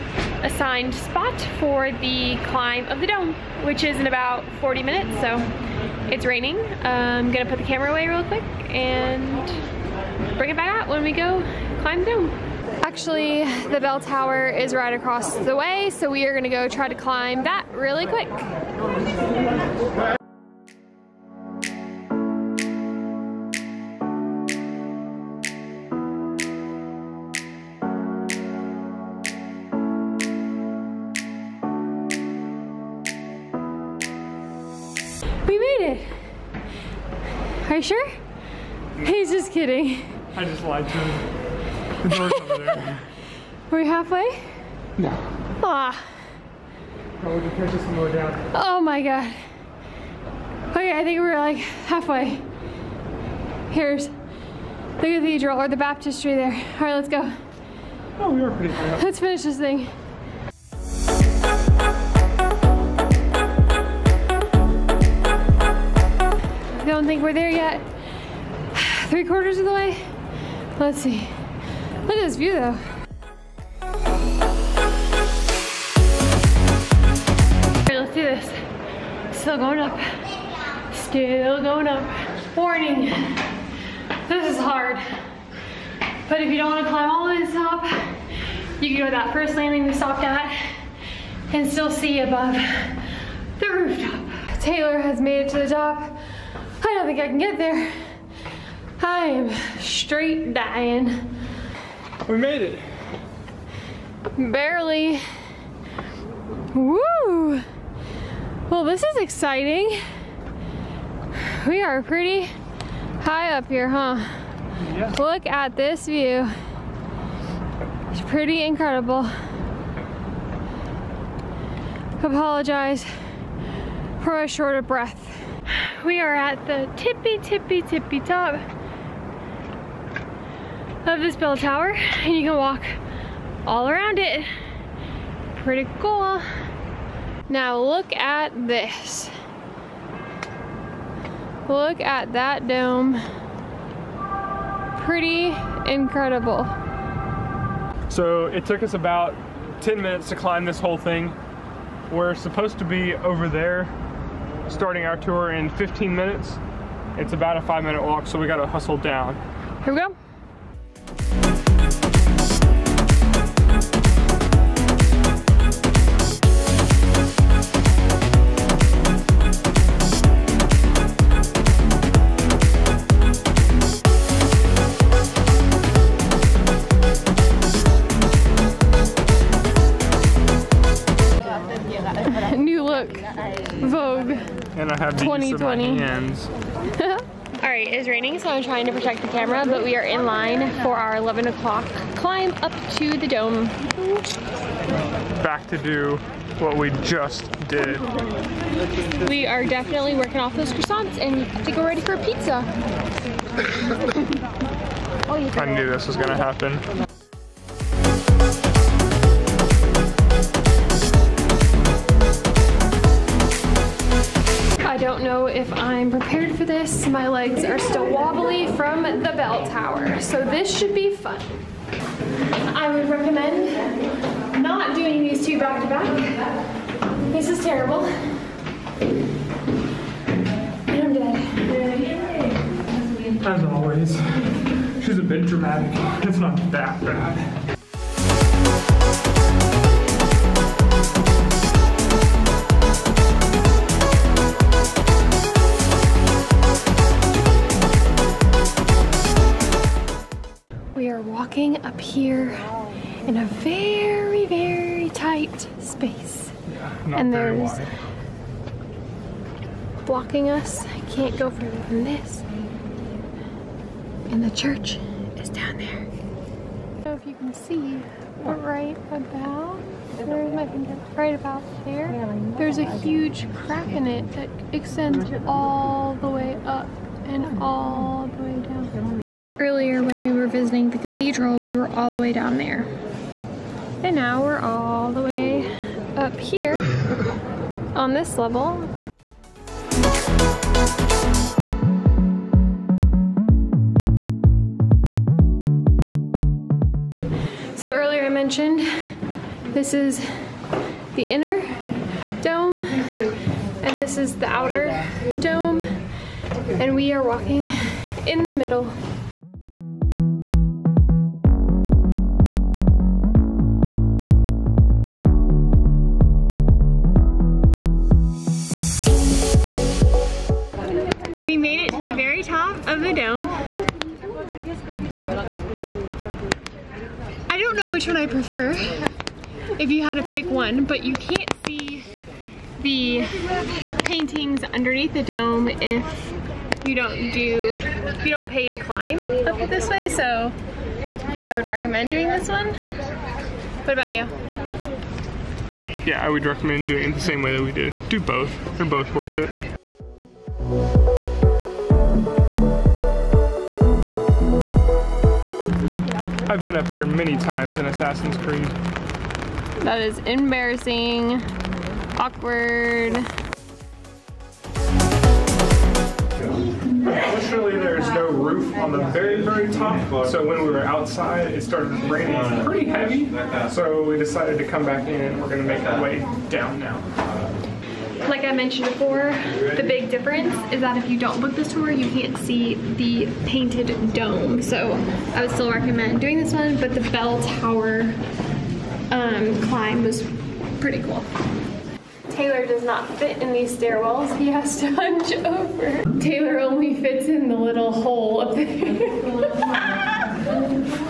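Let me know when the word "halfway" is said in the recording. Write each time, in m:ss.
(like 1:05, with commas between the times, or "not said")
0:43, 0:51.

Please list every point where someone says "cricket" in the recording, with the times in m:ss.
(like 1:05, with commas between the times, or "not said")
not said.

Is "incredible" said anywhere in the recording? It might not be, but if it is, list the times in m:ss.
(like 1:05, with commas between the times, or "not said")
1:58, 2:25.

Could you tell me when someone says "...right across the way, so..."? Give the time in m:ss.
0:14.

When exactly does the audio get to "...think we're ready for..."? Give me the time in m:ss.
3:21.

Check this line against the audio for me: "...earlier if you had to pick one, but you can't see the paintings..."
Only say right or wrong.
wrong.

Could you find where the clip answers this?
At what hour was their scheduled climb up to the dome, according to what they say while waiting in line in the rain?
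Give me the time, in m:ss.
3:11.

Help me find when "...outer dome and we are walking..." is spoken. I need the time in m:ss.
5:04.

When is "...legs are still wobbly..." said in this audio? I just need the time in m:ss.
3:37.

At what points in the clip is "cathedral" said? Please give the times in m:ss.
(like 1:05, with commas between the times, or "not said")
0:55, 4:40.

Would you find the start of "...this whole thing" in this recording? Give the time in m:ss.
2:30.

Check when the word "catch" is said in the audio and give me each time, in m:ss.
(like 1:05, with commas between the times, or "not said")
0:47.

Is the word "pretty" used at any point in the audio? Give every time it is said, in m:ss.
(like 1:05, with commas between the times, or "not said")
0:58, 1:52, 1:58, 2:15, 2:25, 6:12, 6:30.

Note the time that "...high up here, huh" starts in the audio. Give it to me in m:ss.
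1:53.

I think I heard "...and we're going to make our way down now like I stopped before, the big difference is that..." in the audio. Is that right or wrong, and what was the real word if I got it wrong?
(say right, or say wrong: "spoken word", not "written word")
wrong: "mentioned", not "stopped".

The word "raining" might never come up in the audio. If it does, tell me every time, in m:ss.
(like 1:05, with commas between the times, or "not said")
0:06, 3:08, 6:12.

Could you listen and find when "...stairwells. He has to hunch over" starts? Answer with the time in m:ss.
6:33.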